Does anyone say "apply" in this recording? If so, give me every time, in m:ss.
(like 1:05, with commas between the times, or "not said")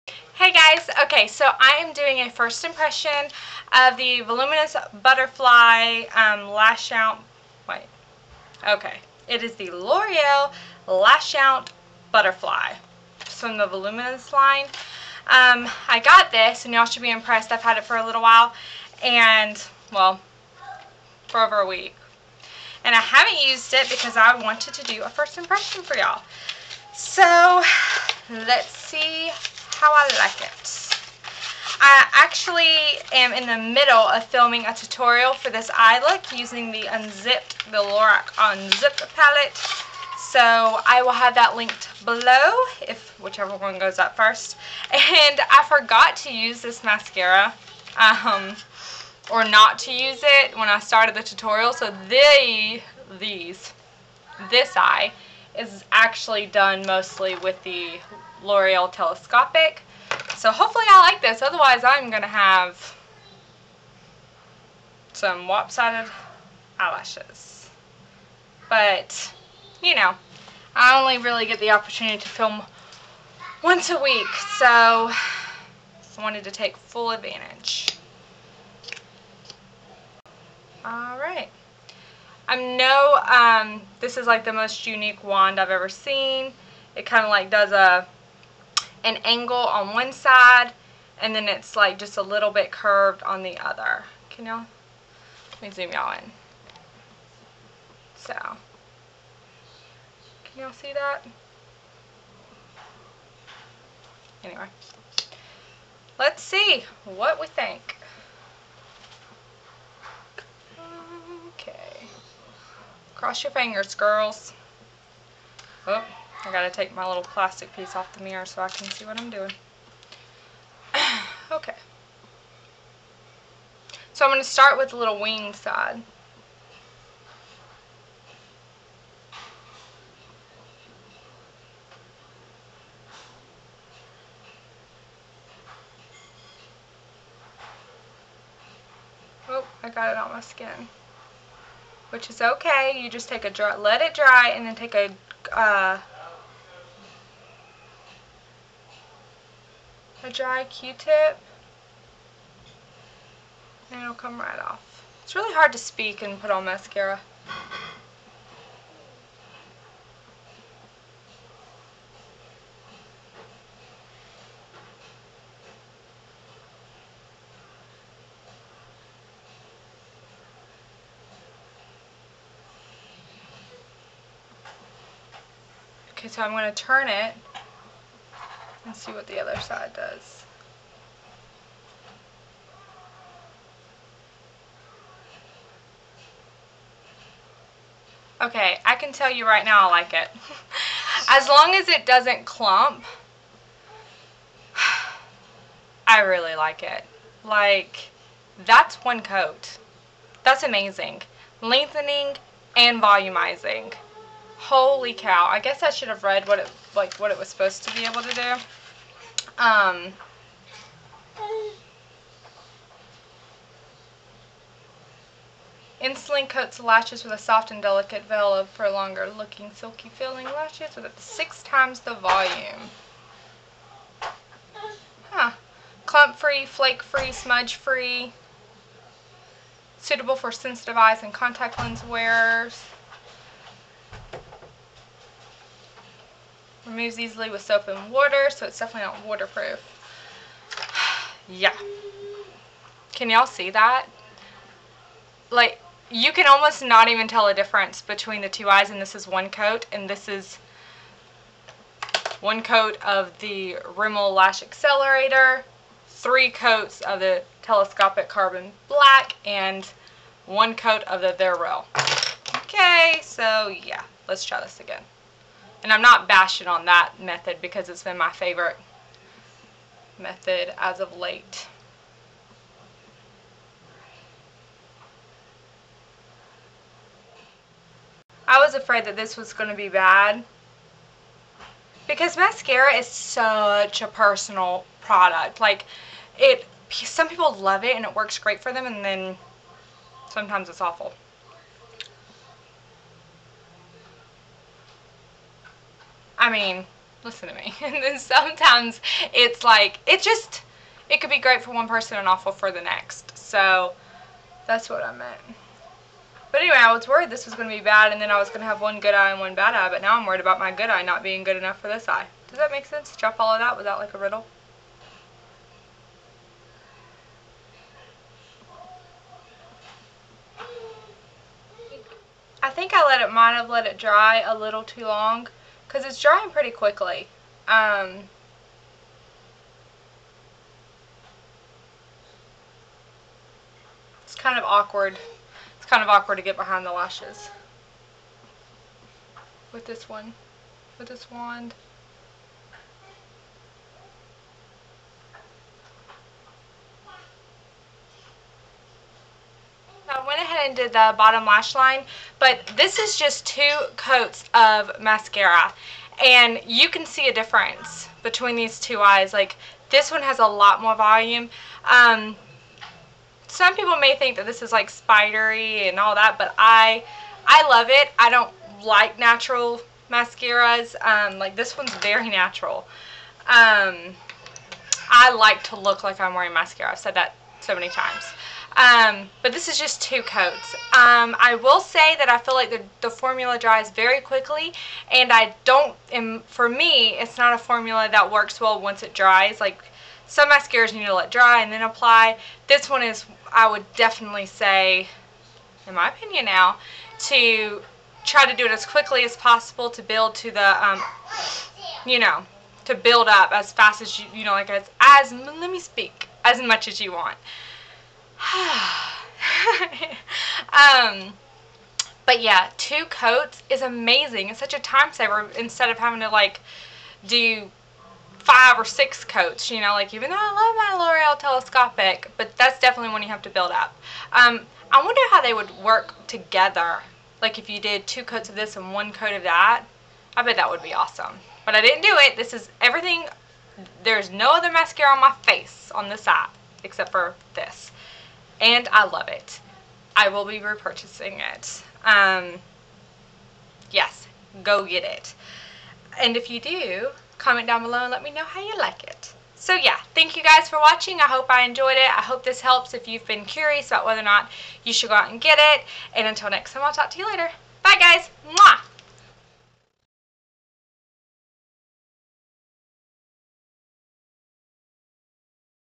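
6:31.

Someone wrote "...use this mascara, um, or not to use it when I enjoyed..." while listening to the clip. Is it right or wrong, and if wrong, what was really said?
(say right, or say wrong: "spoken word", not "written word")
wrong: "started", not "enjoyed".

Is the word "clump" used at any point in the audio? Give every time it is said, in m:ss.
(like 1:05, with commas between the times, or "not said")
3:12, 3:46.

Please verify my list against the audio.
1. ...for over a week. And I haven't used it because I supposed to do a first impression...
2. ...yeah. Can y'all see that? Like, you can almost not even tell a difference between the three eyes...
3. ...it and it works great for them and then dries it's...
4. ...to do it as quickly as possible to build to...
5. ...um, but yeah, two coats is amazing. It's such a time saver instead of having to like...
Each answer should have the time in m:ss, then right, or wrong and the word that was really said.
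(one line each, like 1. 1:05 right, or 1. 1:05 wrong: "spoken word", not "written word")
1. 0:21 wrong: "wanted", not "supposed"
2. 4:01 wrong: "two", not "three"
3. 4:47 wrong: "sometimes", not "dries"
4. 6:38 right
5. 6:50 right.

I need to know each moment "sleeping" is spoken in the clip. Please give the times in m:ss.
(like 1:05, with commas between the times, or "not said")
not said.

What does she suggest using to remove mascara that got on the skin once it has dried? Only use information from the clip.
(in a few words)
dry q-tip.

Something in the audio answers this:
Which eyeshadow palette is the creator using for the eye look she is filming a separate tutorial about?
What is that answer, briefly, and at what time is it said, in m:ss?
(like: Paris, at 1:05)
Lorac Unzipped, at 0:37.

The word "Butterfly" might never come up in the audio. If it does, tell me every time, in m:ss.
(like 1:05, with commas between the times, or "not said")
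0:05, 0:12.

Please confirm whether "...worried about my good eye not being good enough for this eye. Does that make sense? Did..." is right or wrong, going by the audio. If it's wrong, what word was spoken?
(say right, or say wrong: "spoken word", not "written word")
right.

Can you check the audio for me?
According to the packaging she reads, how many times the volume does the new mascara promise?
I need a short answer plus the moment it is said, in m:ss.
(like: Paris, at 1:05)
6 times, at 3:41.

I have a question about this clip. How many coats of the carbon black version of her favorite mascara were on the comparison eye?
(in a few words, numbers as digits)
3.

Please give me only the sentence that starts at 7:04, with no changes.
Um, I wonder how they would work together.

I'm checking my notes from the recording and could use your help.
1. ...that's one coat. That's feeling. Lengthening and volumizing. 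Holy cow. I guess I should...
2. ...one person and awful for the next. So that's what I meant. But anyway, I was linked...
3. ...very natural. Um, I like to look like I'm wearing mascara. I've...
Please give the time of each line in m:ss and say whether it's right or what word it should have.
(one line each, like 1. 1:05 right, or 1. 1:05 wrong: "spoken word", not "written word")
1. 3:18 wrong: "amazing", not "feeling"
2. 5:01 wrong: "worried", not "linked"
3. 6:11 right.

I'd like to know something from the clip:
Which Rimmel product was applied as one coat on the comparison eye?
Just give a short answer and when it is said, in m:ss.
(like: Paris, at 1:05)
Rimmel Lash Accelerator, at 4:13.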